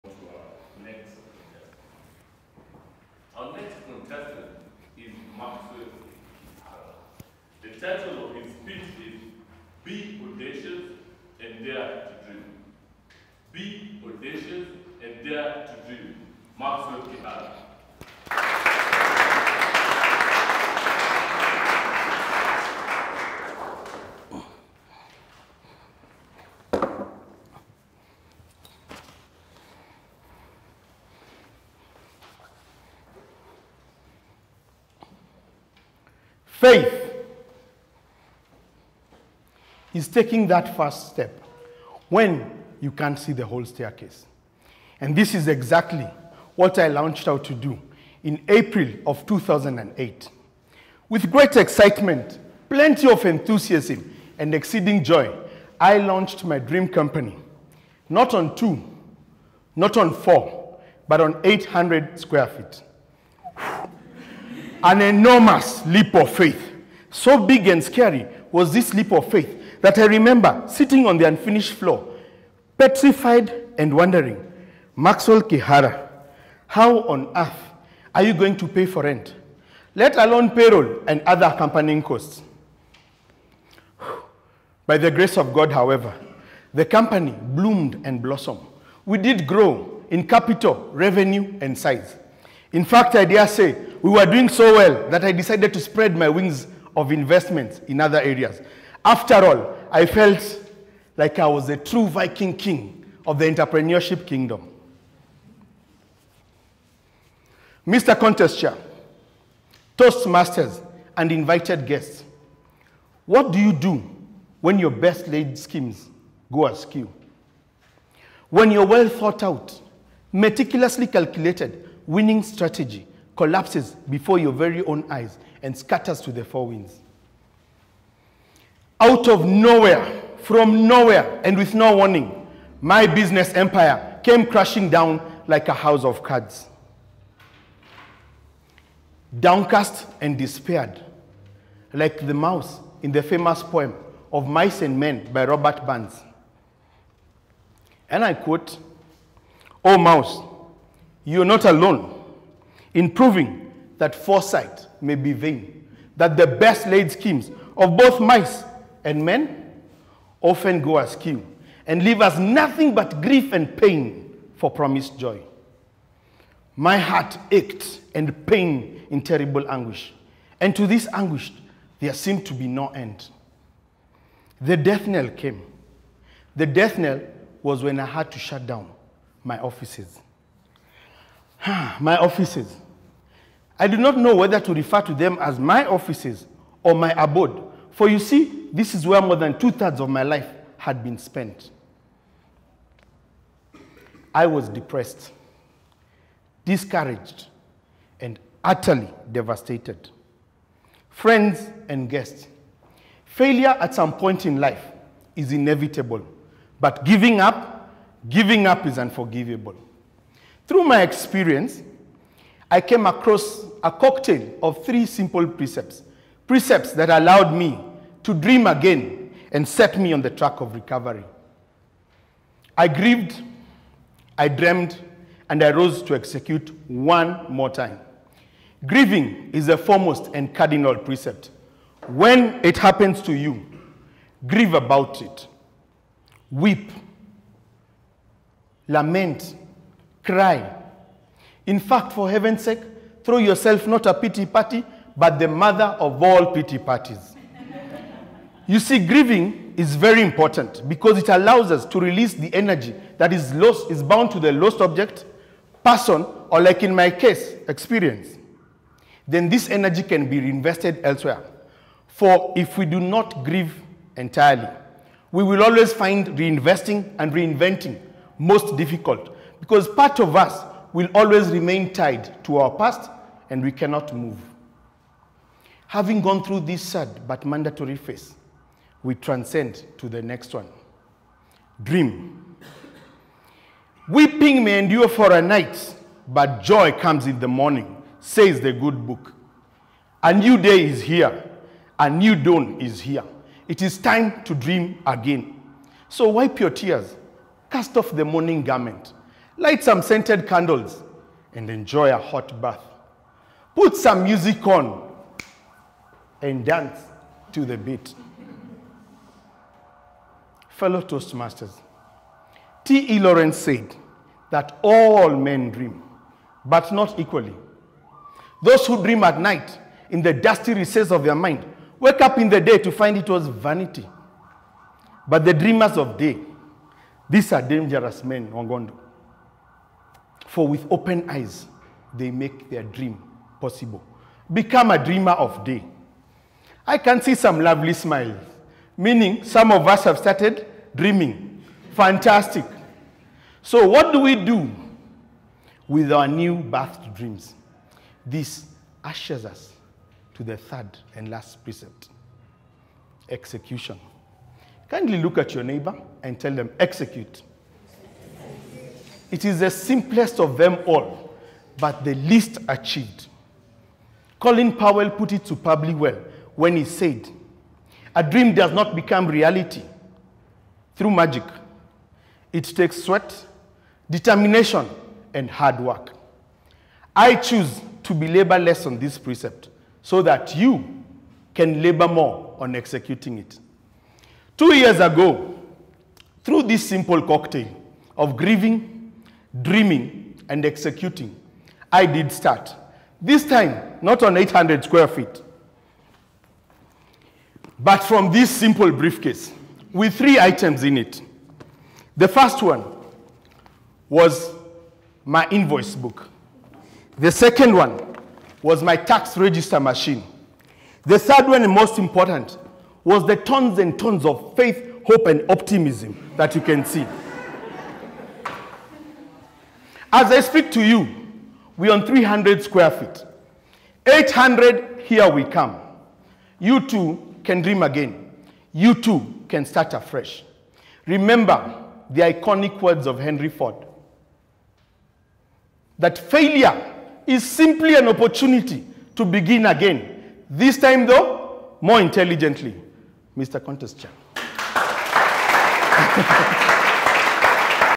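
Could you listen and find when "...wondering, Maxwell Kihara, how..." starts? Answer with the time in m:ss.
1:13.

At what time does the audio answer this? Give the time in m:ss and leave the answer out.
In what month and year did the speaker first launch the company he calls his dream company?
0:48.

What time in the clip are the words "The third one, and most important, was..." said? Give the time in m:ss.
6:51.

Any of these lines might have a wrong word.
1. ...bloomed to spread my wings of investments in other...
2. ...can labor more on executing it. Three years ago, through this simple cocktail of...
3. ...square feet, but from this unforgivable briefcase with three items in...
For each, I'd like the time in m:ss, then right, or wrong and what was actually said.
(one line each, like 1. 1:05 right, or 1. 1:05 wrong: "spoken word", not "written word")
1. 1:35 wrong: "decided", not "bloomed"
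2. 6:21 wrong: "Two", not "Three"
3. 6:34 wrong: "simple", not "unforgivable".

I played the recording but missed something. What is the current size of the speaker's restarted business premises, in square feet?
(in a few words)
300.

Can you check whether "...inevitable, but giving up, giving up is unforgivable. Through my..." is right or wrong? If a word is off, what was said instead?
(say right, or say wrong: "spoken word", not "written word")
right.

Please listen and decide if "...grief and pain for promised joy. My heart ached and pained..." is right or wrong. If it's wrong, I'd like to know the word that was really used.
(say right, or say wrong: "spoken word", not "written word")
right.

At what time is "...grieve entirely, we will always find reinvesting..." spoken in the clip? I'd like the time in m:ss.
4:23.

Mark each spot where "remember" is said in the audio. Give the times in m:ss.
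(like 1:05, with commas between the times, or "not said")
1:10, 7:11.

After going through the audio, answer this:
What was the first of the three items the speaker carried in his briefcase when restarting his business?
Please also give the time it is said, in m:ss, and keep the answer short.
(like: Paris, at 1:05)
Invoice book, at 6:45.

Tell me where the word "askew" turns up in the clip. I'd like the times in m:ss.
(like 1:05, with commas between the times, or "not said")
1:56, 2:40.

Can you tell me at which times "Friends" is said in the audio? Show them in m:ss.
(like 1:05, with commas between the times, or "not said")
3:21.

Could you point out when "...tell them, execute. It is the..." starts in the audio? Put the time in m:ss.
5:56.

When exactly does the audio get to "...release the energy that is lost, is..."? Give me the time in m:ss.
4:11.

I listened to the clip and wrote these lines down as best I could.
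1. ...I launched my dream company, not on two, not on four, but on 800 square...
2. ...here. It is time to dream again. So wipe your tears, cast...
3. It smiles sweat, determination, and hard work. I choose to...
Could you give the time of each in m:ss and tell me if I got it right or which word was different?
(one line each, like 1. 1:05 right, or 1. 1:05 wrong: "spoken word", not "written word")
1. 0:55 right
2. 4:53 right
3. 6:12 wrong: "takes", not "smiles".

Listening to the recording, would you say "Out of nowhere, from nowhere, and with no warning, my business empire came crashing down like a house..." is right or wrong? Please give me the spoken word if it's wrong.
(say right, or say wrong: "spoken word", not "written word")
right.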